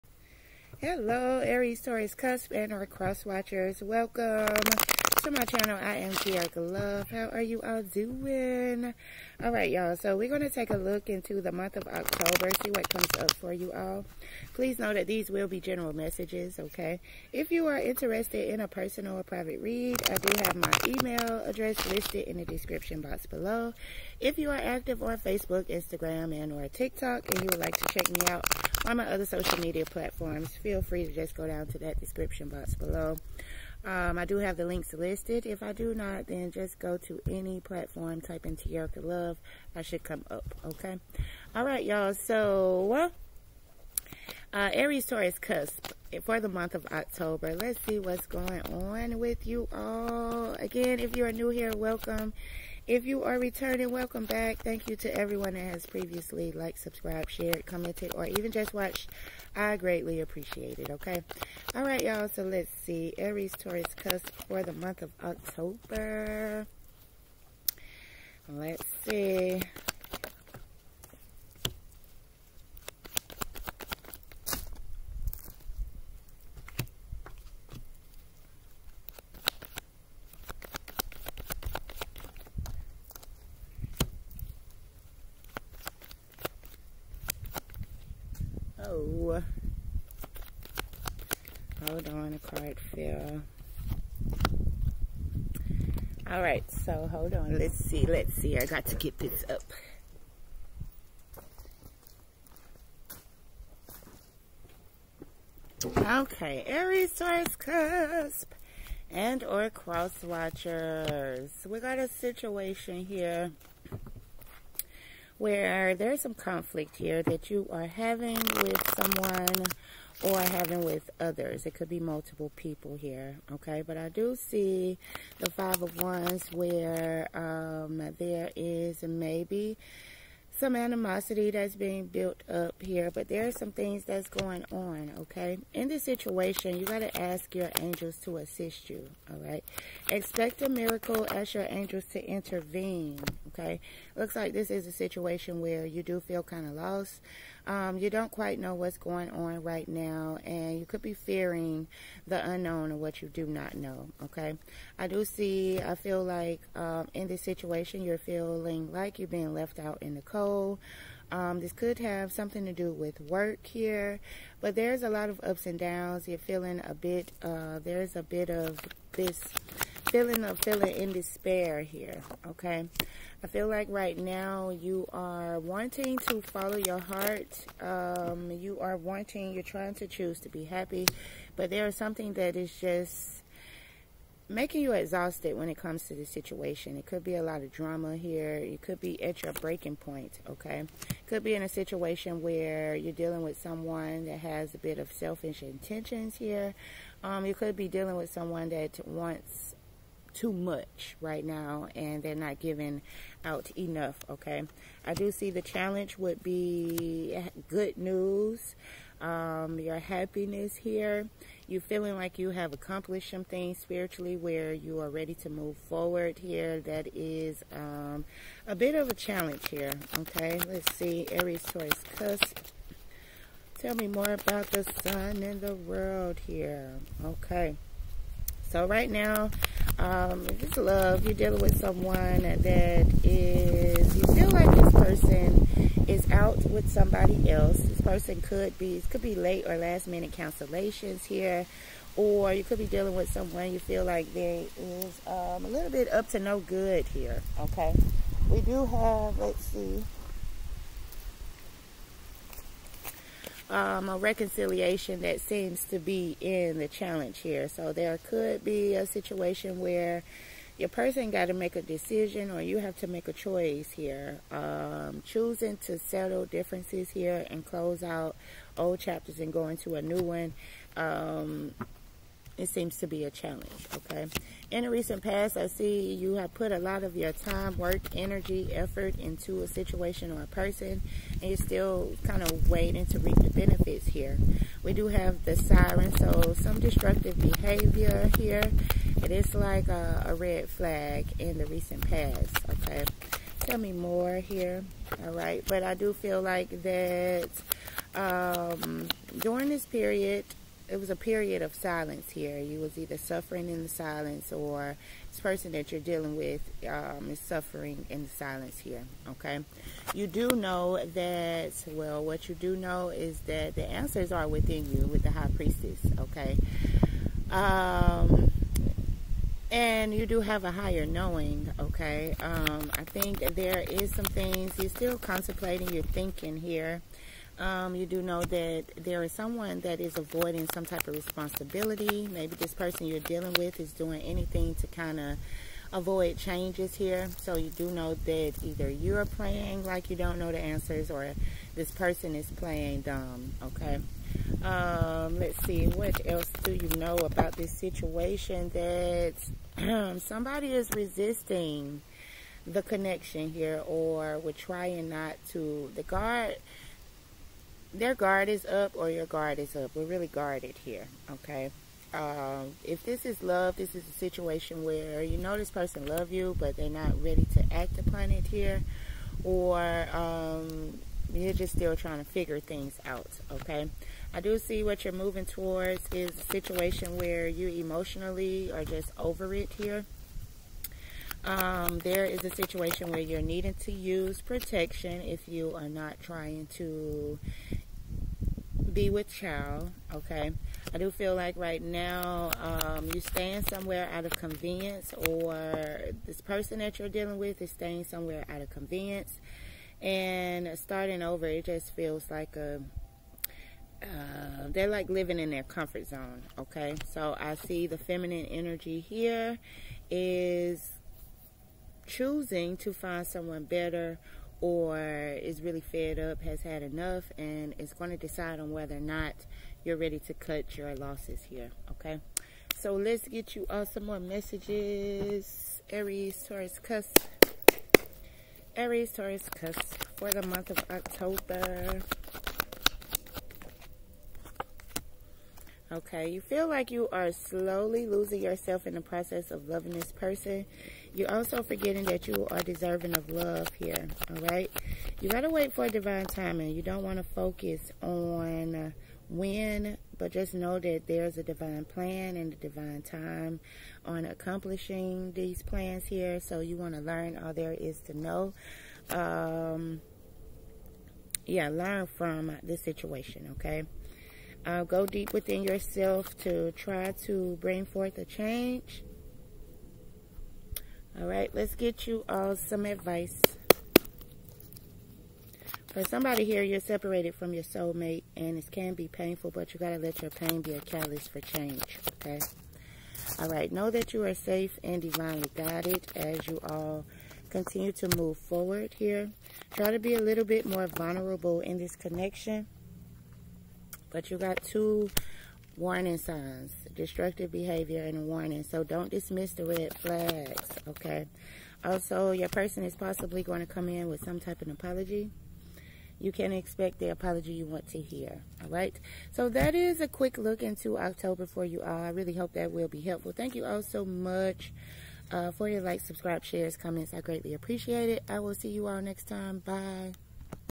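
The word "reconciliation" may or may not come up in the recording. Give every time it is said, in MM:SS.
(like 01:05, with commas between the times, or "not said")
04:14.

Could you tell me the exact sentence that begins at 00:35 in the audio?
If I do not, then just go to any platform, type in Tericka Love.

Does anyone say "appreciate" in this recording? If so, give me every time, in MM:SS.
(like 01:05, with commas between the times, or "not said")
01:00, 08:37.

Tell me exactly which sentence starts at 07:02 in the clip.
So let's get you all some more messages.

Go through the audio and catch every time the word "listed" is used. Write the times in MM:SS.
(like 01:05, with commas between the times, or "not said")
00:21, 00:34.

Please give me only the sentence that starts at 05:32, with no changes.
Maybe this person you're dealing with is doing anything to kind of avoid changes here.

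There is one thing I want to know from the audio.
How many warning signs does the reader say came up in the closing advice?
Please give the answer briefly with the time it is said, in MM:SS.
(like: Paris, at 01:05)
2, at 08:14.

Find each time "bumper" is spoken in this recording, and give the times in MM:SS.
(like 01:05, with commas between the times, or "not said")
not said.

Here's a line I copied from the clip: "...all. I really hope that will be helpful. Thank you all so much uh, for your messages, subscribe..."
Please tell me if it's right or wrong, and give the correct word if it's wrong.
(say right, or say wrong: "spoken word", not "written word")
wrong: "likes", not "messages".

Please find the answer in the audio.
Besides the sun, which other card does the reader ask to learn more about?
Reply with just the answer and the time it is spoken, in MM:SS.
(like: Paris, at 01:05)
The world, at 03:45.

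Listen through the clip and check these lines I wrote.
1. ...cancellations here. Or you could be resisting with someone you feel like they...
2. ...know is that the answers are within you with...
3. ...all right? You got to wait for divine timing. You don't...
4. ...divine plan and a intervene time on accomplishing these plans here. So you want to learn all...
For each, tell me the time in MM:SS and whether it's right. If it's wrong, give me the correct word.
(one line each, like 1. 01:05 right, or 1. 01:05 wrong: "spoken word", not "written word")
1. 04:00 wrong: "dealing", not "resisting"
2. 05:12 right
3. 07:24 right
4. 07:31 wrong: "divine", not "intervene".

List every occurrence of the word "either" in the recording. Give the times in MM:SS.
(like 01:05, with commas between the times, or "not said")
05:02, 05:38.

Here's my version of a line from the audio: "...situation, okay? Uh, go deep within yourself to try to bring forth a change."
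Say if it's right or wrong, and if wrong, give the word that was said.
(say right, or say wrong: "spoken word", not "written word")
right.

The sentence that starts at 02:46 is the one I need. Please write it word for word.
You're feeling a bit, uh, there's a bit of this feeling of feeling in despair here, okay?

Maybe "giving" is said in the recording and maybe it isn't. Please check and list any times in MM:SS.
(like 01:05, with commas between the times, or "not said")
03:22.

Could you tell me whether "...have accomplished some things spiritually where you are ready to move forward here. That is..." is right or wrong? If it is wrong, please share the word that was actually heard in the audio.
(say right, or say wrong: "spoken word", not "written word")
right.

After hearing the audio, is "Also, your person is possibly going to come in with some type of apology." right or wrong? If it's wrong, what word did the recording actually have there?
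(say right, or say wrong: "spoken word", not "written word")
right.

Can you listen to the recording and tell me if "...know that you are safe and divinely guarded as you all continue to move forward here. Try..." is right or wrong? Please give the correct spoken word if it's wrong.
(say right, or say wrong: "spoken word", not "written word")
wrong: "guided", not "guarded".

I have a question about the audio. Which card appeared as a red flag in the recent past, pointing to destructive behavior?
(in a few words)
The siren.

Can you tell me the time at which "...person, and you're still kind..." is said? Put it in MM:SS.
04:40.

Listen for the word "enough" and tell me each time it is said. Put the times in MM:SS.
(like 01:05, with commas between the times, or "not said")
03:23, 06:56.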